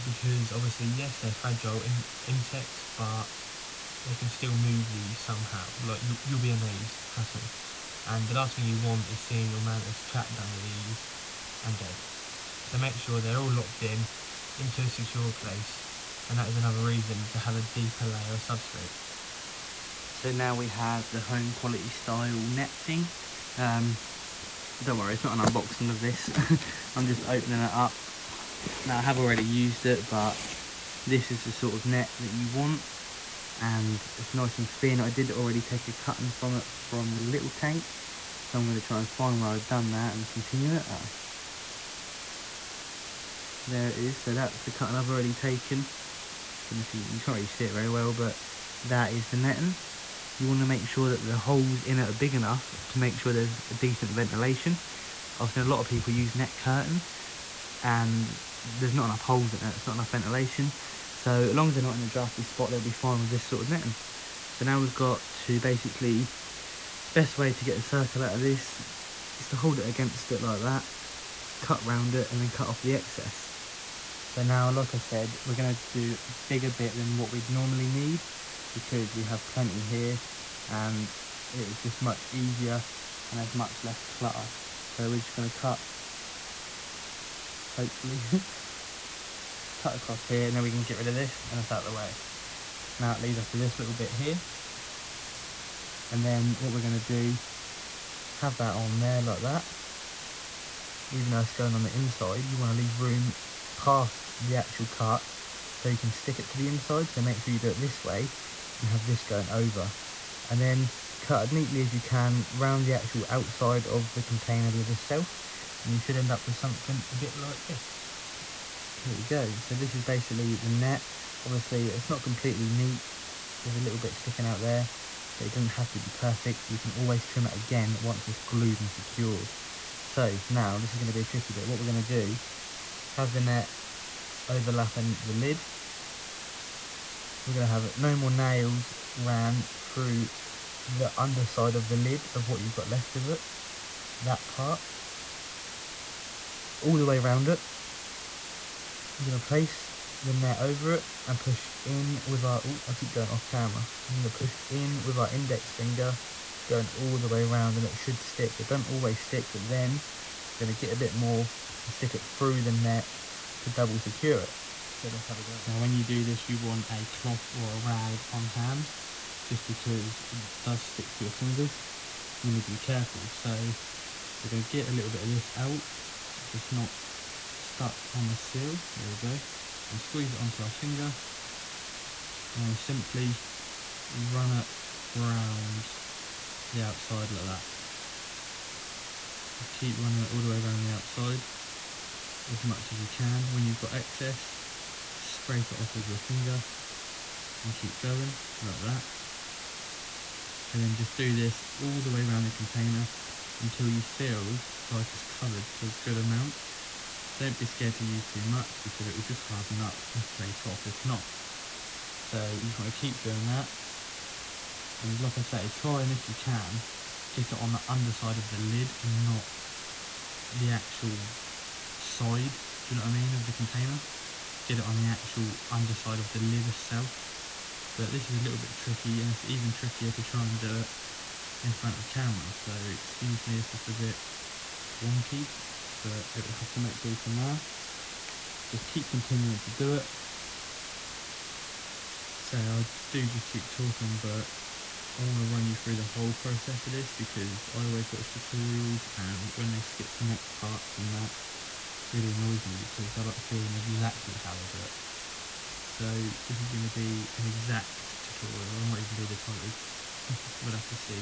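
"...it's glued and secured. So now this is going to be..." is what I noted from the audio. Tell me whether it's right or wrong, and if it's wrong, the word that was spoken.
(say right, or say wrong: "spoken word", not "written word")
right.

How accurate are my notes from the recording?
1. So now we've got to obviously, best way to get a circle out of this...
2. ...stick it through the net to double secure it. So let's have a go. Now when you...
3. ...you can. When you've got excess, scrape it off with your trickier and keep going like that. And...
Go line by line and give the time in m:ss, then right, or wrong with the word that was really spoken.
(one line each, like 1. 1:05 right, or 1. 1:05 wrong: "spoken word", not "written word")
1. 1:04 wrong: "basically", not "obviously"
2. 2:41 right
3. 3:12 wrong: "finger", not "trickier".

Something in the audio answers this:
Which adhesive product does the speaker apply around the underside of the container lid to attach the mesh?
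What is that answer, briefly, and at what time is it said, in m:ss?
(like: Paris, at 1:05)
No More Nails, at 2:17.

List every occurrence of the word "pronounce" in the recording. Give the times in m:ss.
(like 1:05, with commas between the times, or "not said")
not said.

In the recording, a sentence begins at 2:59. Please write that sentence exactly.
And gonna squeeze it onto our finger and simply run it round the outside like that.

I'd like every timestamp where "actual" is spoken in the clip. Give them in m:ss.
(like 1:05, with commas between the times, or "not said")
1:44, 1:52, 3:40, 3:45.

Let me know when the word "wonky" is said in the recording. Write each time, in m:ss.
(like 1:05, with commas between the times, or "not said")
3:55.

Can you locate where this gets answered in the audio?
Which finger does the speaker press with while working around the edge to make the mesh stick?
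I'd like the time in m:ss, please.
2:35.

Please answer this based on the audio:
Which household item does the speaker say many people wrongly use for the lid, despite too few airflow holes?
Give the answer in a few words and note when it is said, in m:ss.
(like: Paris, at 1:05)
net curtain, at 0:56.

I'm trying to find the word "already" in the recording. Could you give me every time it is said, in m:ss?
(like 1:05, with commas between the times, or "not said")
0:29, 0:35, 0:45.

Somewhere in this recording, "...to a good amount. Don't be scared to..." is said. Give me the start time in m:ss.
3:25.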